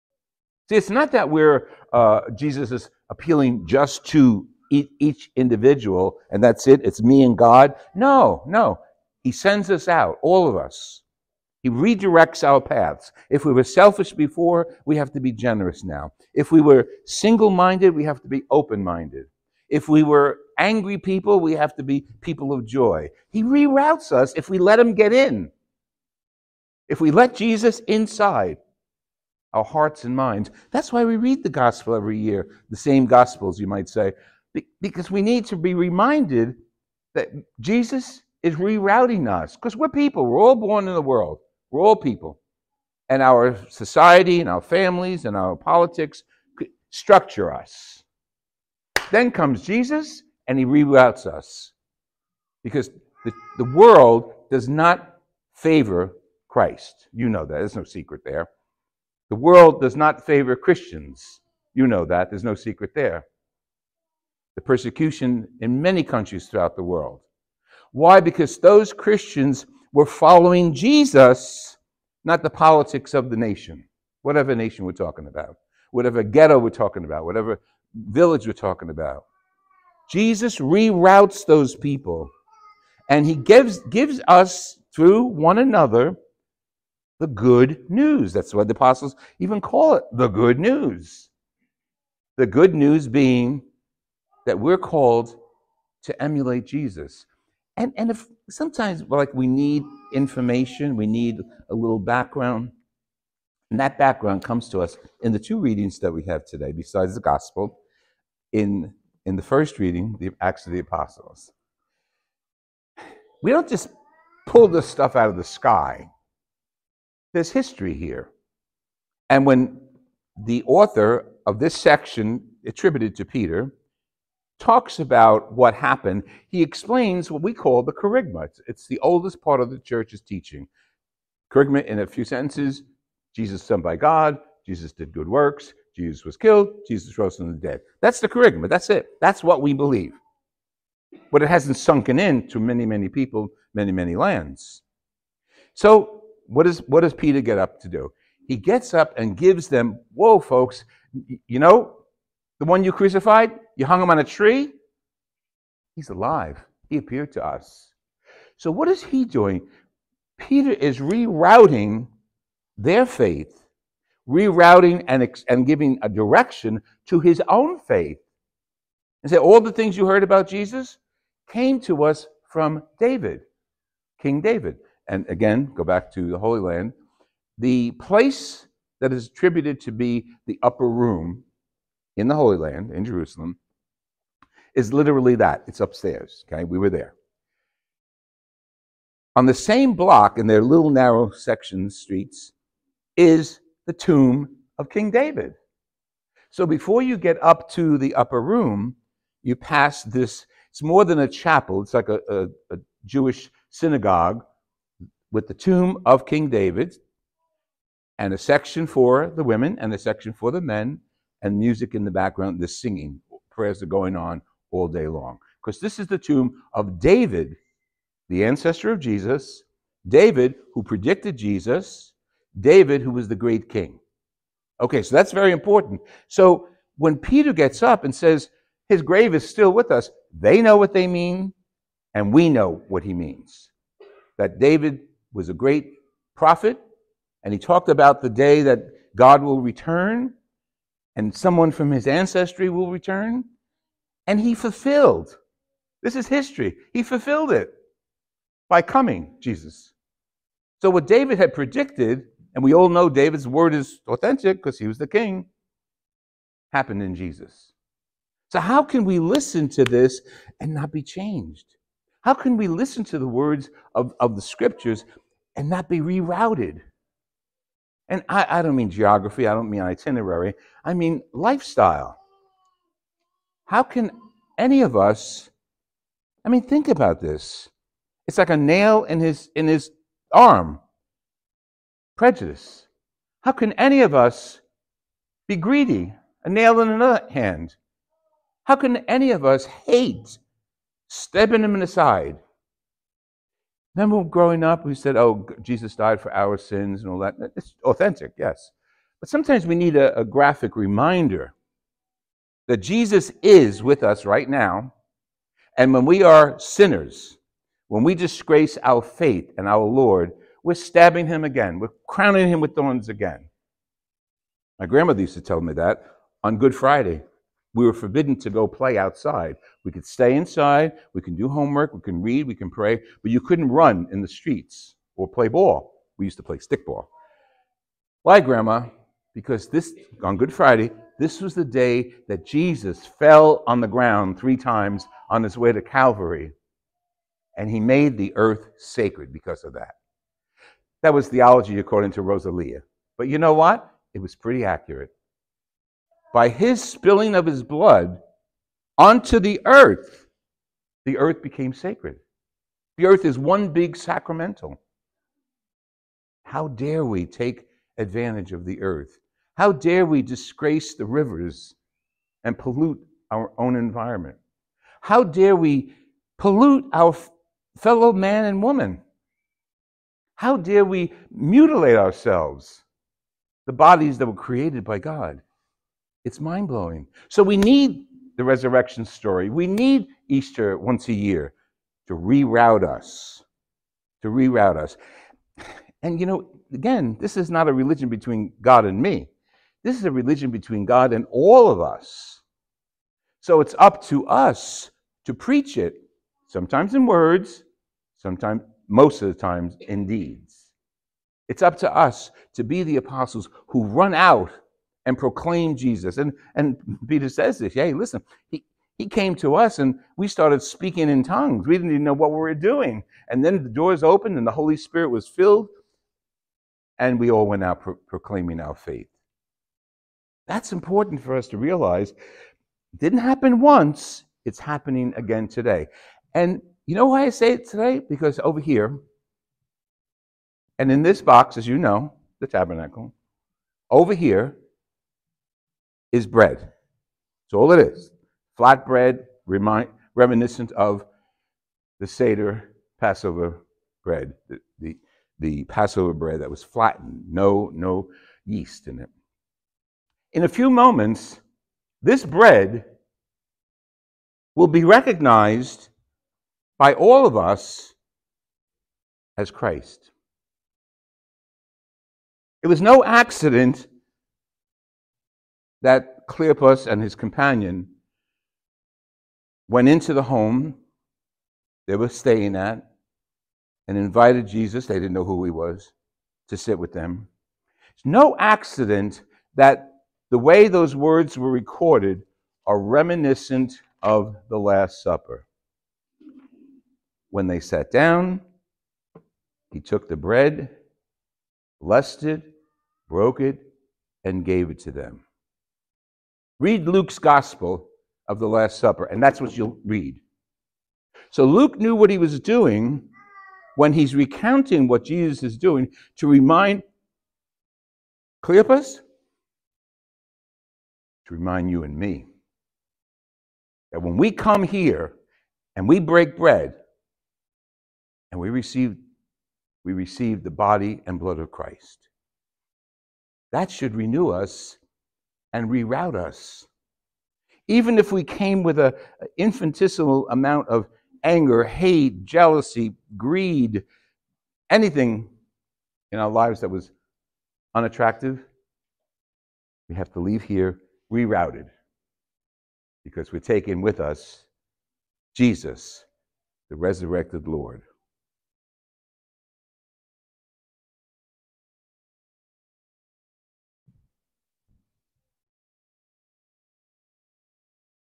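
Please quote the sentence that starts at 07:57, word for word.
It's no accident that the way those words were recorded are reminiscent of the Last Supper.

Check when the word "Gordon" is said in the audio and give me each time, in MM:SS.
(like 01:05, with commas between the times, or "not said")
not said.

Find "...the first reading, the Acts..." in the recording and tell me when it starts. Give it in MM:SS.
01:49.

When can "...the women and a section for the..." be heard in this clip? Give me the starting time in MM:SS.
03:29.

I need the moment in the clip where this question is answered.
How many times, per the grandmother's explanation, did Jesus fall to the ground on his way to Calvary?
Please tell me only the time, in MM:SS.
05:34.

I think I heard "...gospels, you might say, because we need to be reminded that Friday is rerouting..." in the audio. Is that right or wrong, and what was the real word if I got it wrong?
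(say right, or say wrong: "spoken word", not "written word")
wrong: "Jesus", not "Friday".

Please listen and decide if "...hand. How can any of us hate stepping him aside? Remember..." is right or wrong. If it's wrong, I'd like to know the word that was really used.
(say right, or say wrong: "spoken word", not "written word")
right.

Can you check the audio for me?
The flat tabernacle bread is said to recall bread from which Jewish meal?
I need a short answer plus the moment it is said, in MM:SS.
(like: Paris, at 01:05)
Seder Passover, at 07:22.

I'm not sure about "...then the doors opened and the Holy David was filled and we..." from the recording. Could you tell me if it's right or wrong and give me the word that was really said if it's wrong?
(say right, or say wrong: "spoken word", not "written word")
wrong: "Spirit", not "David".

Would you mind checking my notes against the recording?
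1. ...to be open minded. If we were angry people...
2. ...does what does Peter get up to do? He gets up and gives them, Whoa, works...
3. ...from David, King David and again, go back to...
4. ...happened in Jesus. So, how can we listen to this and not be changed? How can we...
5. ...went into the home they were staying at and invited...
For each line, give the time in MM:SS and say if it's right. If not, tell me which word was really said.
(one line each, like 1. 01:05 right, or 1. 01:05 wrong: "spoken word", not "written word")
1. 00:18 right
2. 02:26 wrong: "folks", not "works"
3. 02:52 right
4. 04:16 right
5. 07:49 right.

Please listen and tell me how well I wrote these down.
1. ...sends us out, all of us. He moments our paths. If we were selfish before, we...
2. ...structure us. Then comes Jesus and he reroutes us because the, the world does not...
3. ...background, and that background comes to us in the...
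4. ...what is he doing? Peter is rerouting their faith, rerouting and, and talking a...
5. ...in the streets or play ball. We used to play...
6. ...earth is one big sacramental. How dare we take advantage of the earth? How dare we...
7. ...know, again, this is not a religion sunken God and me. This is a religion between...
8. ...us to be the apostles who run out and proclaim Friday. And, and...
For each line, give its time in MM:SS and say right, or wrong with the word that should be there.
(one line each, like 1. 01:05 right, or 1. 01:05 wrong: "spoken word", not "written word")
1. 00:09 wrong: "redirects", not "moments"
2. 00:46 right
3. 01:41 right
4. 02:38 wrong: "giving", not "talking"
5. 05:24 right
6. 05:53 right
7. 06:26 wrong: "between", not "sunken"
8. 06:41 wrong: "Jesus", not "Friday".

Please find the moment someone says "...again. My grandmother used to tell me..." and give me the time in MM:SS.
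05:13.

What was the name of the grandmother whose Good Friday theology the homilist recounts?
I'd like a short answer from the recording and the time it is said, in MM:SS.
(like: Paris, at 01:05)
Rosalia, at 05:42.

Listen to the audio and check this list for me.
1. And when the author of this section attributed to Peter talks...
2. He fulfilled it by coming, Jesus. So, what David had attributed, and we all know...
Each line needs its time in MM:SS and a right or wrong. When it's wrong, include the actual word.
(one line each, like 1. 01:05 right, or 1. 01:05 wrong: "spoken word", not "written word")
1. 01:59 right
2. 04:06 wrong: "predicted", not "attributed".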